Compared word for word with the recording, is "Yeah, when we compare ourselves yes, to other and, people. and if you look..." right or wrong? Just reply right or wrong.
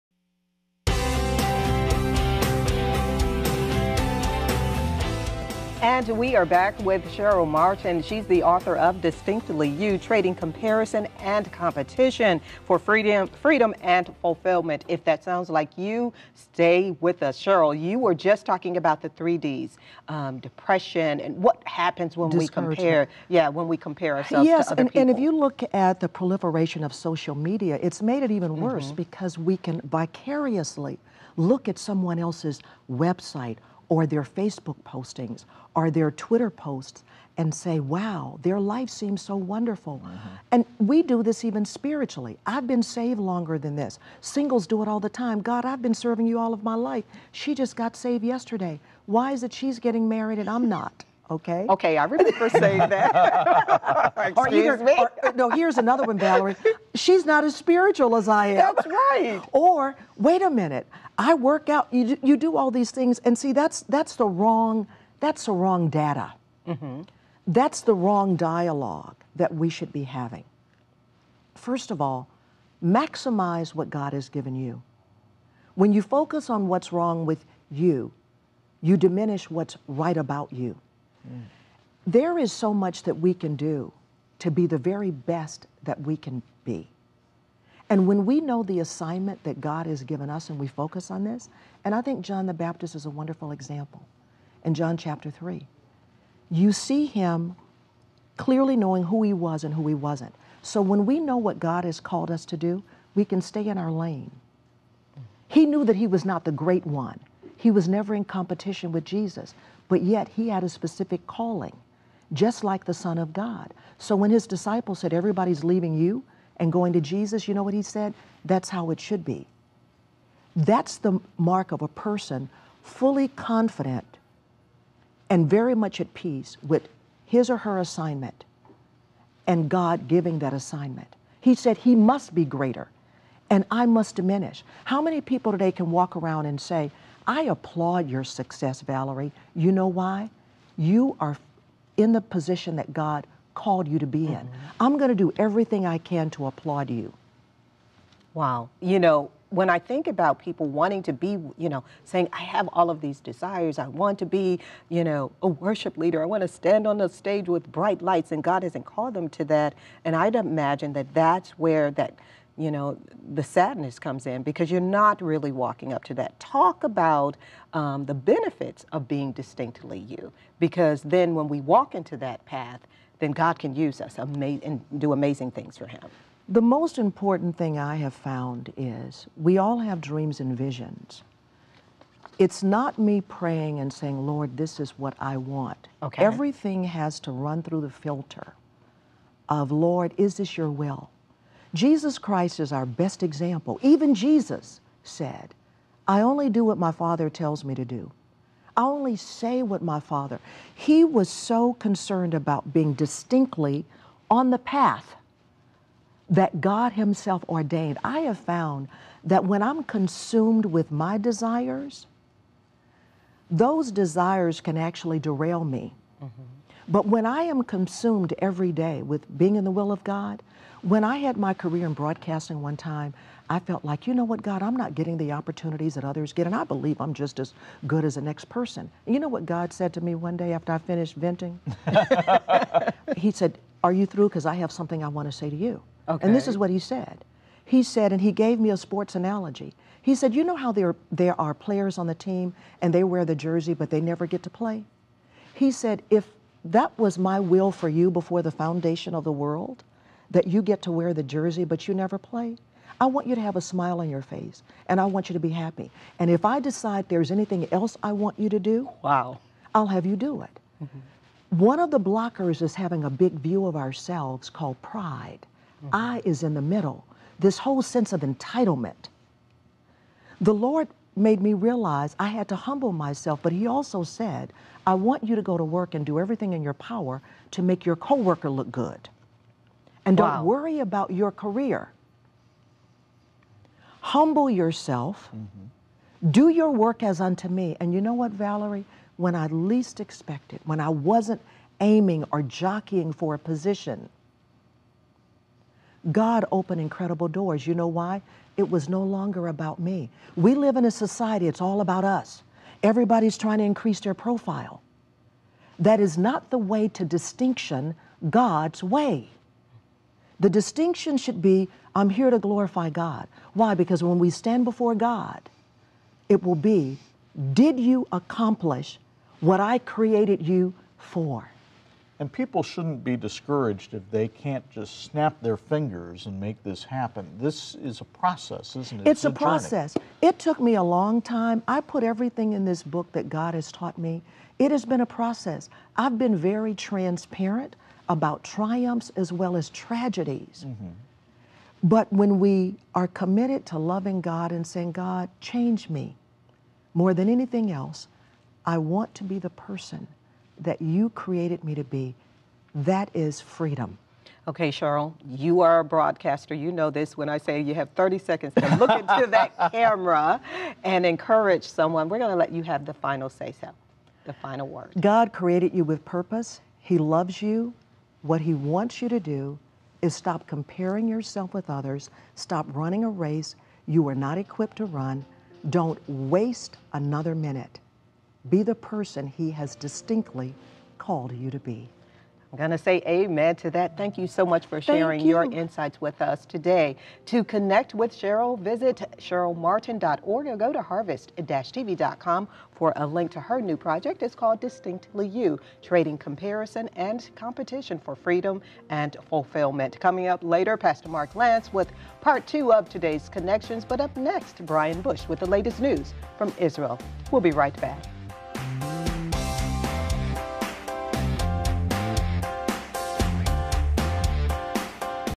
right.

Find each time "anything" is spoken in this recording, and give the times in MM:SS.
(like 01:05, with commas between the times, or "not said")
04:17, 05:47.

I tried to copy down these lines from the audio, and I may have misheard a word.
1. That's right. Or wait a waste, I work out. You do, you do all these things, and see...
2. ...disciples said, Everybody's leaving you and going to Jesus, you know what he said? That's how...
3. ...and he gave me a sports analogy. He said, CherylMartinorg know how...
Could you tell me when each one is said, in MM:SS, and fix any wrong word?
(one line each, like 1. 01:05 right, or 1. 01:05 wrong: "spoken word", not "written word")
1. 00:58 wrong: "minute", not "waste"
2. 01:54 right
3. 03:58 wrong: "You", not "CherylMartinorg".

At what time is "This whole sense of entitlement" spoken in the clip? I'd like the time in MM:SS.
04:27.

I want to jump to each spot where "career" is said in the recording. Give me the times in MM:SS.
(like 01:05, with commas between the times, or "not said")
03:41, 04:41.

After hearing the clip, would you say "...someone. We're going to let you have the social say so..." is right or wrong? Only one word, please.
wrong.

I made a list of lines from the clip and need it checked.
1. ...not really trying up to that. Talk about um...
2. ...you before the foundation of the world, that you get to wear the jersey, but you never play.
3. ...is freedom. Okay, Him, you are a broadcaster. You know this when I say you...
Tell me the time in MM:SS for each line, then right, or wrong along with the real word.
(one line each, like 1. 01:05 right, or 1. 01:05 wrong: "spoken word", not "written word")
1. 02:44 wrong: "walking", not "trying"
2. 04:07 right
3. 05:53 wrong: "Cheryl", not "Him".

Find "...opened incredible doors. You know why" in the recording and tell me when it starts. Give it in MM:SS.
04:56.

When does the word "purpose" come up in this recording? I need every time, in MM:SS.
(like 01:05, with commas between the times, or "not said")
06:06.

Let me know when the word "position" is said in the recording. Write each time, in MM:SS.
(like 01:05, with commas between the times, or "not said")
02:22, 04:53.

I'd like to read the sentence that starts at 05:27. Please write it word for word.
This is a process, isn't it?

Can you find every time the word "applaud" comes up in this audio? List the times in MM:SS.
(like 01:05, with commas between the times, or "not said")
02:17, 02:26.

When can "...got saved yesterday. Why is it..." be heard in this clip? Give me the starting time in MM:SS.
00:47.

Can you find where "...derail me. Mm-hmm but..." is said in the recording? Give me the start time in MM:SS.
03:35.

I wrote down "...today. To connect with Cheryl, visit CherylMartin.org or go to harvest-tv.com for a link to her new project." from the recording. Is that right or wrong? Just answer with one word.
right.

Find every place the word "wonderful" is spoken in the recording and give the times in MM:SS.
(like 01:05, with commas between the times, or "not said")
00:39, 01:33.